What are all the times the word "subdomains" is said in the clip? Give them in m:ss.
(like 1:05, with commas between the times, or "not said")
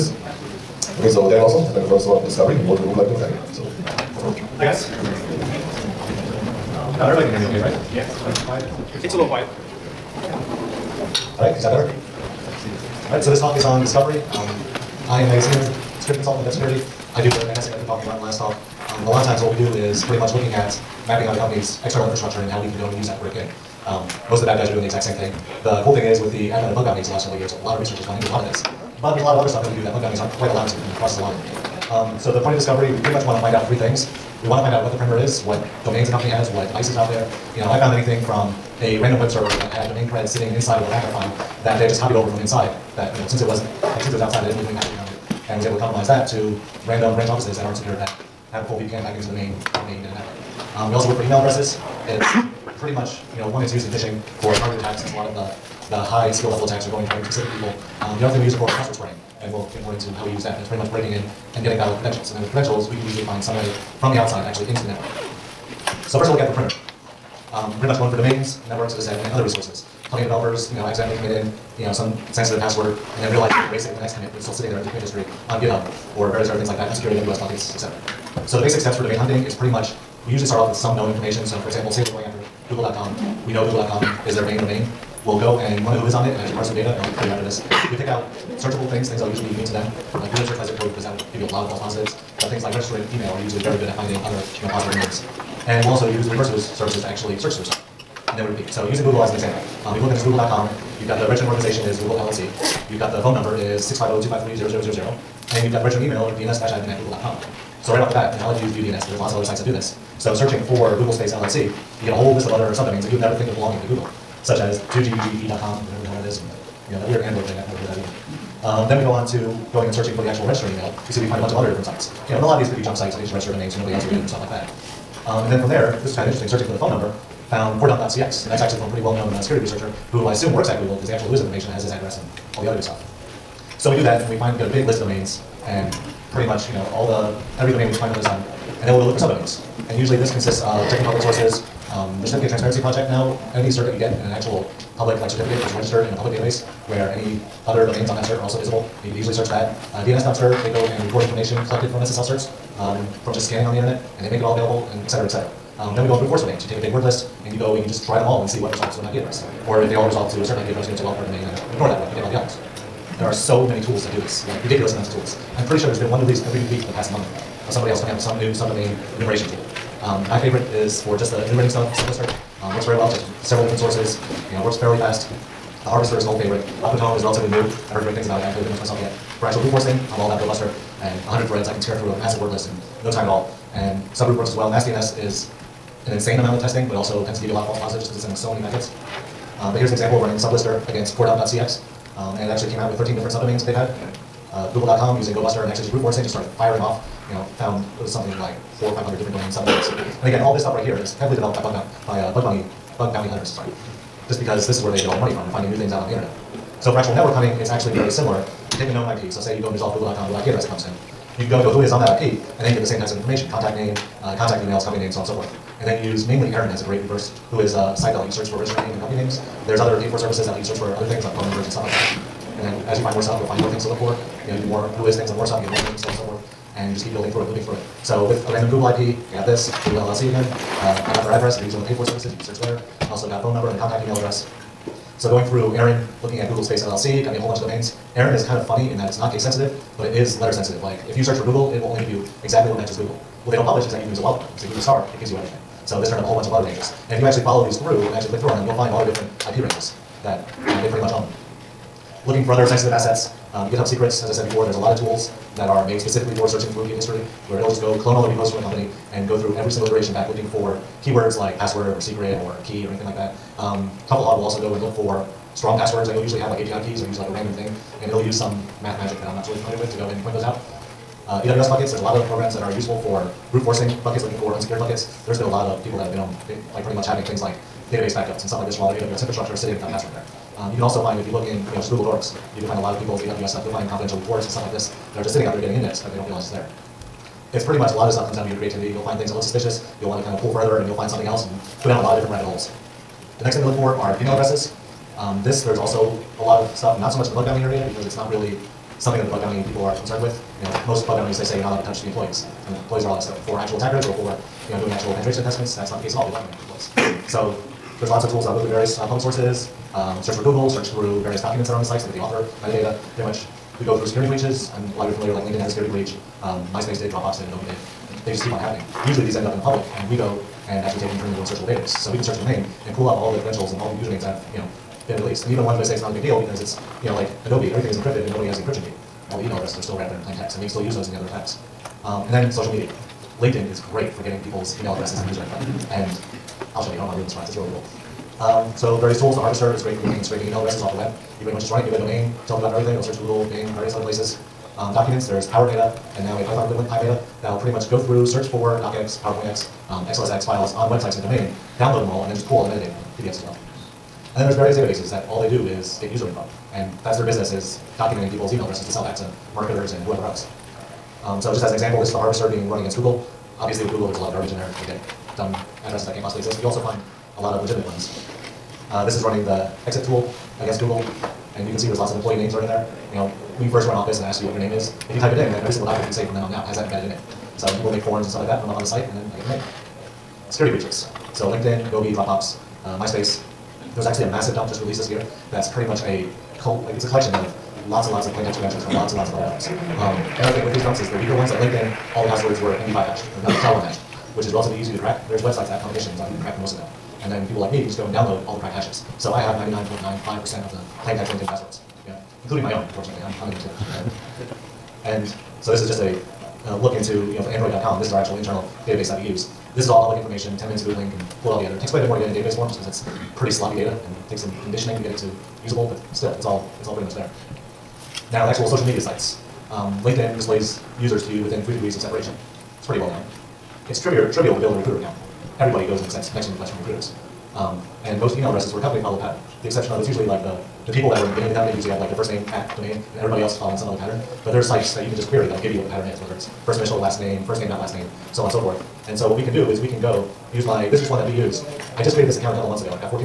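1:52, 2:19, 2:48, 3:13, 3:19.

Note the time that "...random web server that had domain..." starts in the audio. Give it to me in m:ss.
0:39.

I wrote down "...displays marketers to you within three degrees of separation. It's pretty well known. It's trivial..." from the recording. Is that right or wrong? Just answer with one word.
wrong.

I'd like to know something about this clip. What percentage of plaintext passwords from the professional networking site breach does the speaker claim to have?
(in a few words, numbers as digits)
99.95%.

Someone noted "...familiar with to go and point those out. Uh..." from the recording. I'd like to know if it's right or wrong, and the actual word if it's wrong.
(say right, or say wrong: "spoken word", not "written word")
right.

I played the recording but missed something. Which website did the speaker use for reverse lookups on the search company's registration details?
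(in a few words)
ViewDNS.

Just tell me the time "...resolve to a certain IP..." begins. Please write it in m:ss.
2:40.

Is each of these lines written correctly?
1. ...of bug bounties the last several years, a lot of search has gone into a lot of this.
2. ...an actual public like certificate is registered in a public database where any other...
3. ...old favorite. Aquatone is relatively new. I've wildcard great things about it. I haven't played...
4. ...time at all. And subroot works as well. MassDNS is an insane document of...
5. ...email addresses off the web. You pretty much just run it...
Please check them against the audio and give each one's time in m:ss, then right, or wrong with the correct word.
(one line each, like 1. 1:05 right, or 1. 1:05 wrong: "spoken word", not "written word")
1. 0:26 wrong: "research", not "search"
2. 2:24 right
3. 2:56 wrong: "heard", not "wildcard"
4. 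3:03 wrong: "amount", not "document"
5. 5:40 right.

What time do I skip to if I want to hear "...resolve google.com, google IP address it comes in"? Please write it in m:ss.
3:29.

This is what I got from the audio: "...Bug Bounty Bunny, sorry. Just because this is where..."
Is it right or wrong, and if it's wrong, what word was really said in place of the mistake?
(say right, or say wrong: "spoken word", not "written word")
wrong: "Hunters", not "Bunny".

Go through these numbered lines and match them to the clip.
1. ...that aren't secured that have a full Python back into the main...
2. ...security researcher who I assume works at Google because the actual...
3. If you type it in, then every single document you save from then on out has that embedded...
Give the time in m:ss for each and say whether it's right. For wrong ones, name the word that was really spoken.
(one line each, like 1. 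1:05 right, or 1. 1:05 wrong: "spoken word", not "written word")
1. 0:47 wrong: "VPN", not "Python"
2. 2:09 right
3. 6:15 right.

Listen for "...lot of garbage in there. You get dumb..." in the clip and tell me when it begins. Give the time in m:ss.
6:04.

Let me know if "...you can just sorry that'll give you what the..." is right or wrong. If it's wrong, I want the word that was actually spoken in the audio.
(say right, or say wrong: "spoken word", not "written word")
wrong: "query", not "sorry".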